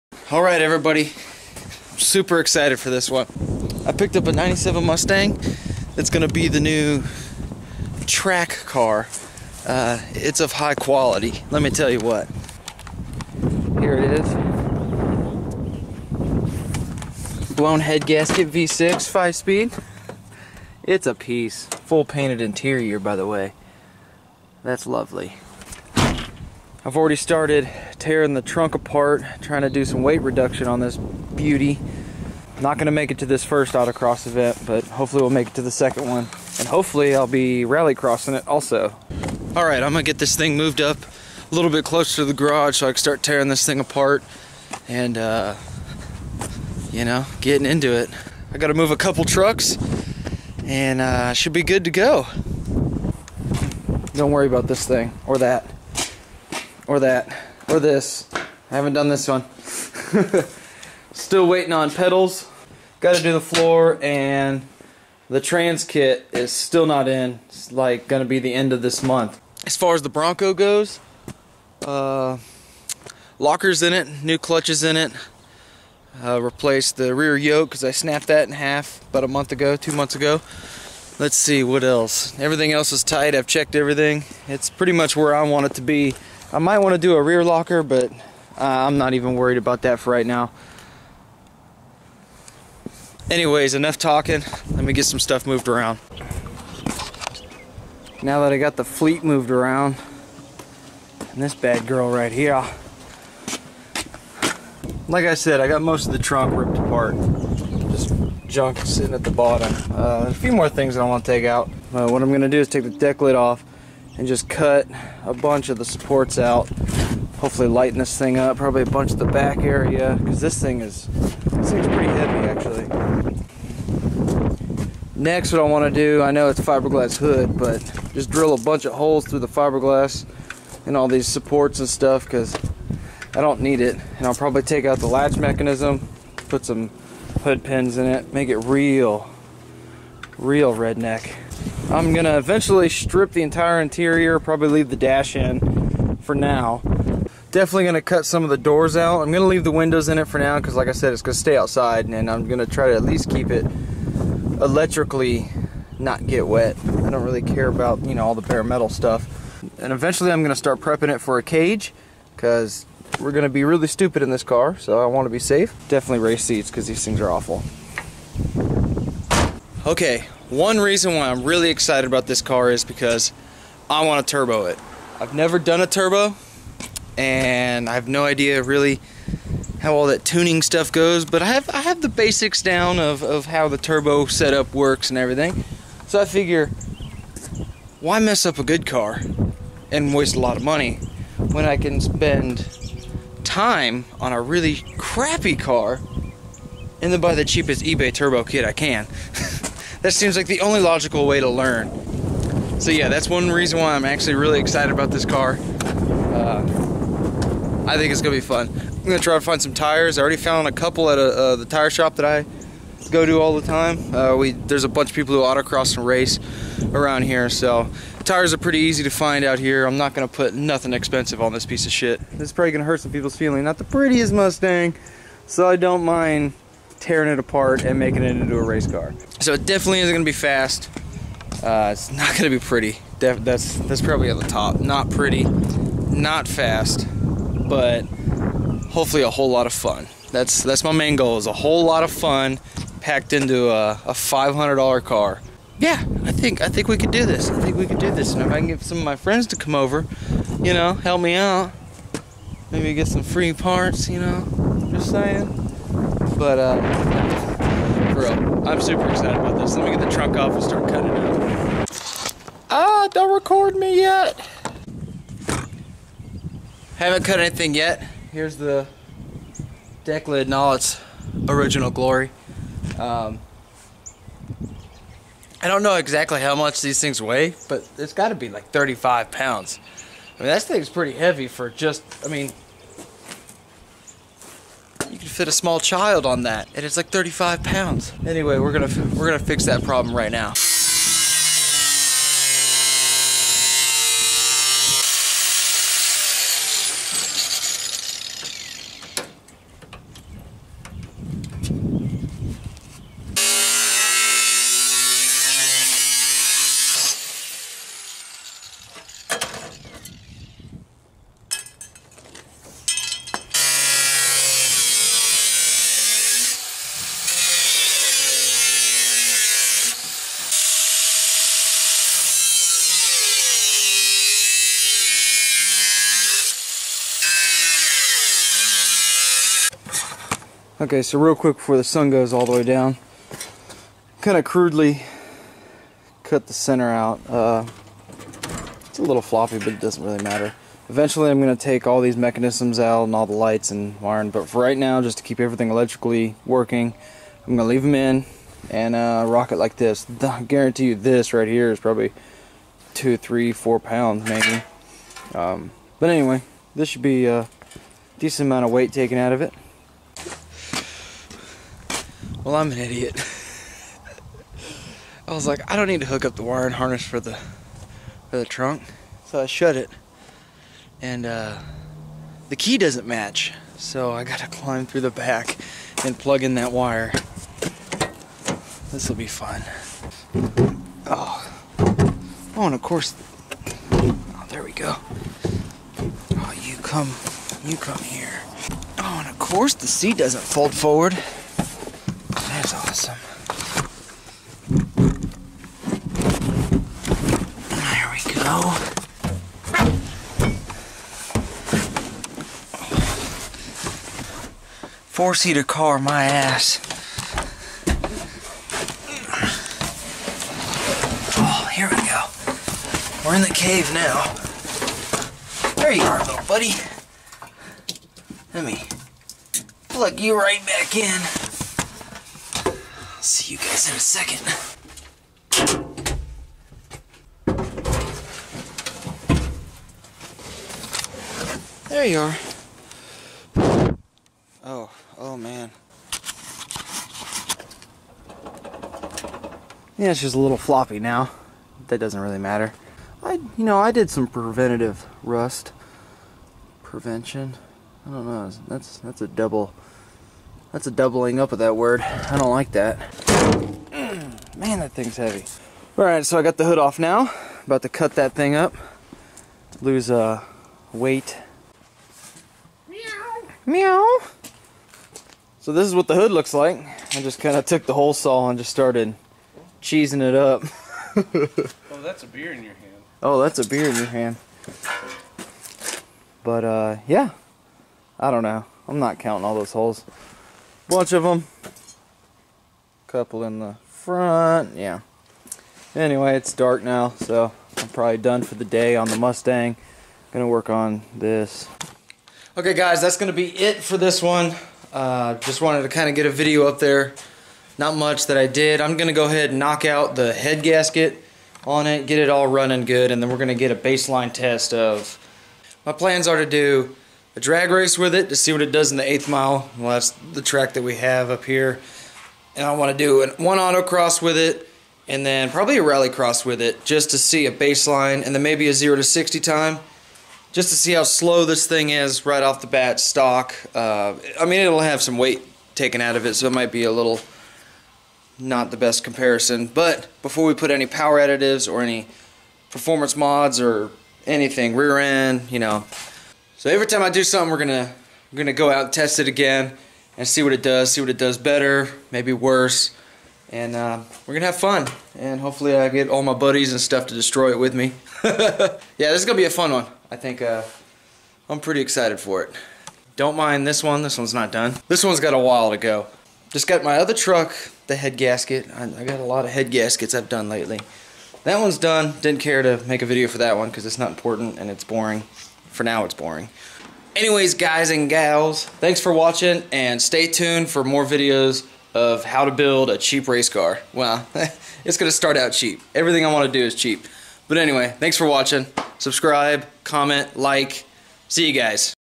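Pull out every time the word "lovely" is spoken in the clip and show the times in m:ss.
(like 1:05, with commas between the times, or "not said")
0:24.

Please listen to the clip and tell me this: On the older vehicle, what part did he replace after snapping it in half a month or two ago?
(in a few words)
rear yoke.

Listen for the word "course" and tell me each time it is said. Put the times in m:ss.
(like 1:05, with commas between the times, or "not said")
6:22, 6:29.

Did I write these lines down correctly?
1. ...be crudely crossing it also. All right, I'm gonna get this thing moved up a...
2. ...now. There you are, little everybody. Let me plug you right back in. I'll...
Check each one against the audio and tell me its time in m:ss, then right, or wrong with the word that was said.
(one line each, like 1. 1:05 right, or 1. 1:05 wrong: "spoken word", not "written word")
1. 0:37 wrong: "rally", not "crudely"
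2. 6:53 wrong: "buddy", not "everybody".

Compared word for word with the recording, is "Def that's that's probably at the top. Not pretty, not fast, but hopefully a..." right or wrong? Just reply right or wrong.
right.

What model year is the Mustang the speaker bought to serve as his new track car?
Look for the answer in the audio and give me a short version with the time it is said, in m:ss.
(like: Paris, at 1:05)
1997, at 0:04.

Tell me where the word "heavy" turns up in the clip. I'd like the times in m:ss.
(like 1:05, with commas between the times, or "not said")
2:02, 4:41, 7:35.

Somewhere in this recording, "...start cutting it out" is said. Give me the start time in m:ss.
4:20.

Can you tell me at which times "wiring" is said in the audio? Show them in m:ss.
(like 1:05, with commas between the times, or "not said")
5:44, 6:06.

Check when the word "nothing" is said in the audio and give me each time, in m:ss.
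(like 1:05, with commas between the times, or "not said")
3:40.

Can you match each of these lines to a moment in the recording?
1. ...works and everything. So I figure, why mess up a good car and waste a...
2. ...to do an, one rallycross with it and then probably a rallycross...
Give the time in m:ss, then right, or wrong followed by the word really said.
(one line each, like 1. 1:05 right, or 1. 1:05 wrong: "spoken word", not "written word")
1. 3:04 right
2. 8:32 wrong: "autocross", not "rallycross".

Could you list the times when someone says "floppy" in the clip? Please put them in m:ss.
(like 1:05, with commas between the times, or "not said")
5:39, 7:20.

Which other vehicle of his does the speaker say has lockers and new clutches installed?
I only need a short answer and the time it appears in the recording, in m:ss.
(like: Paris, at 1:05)
Bronco, at 1:10.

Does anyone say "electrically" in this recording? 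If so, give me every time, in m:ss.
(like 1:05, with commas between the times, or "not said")
2:34, 5:45.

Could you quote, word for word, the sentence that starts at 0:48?
I gotta move a couple trucks and uh, should be good to go.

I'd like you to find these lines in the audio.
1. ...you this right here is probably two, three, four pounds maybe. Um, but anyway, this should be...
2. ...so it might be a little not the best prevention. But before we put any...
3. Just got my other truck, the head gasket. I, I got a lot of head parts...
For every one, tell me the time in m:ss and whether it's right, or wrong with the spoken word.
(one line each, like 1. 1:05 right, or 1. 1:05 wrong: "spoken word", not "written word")
1. 5:50 right
2. 8:46 wrong: "comparison", not "prevention"
3. 9:16 wrong: "gaskets", not "parts".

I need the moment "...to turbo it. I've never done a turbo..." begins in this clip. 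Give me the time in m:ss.
2:54.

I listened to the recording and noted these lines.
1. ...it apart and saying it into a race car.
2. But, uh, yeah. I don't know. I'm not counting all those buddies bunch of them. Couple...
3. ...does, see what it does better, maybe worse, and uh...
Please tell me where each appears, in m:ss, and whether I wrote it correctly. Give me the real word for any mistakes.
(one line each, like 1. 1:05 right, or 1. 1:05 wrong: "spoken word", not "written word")
1. 3:47 wrong: "making", not "saying"
2. 7:56 wrong: "holes", not "buddies"
3. 9:00 right.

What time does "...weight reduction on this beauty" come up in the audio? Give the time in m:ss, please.
0:30.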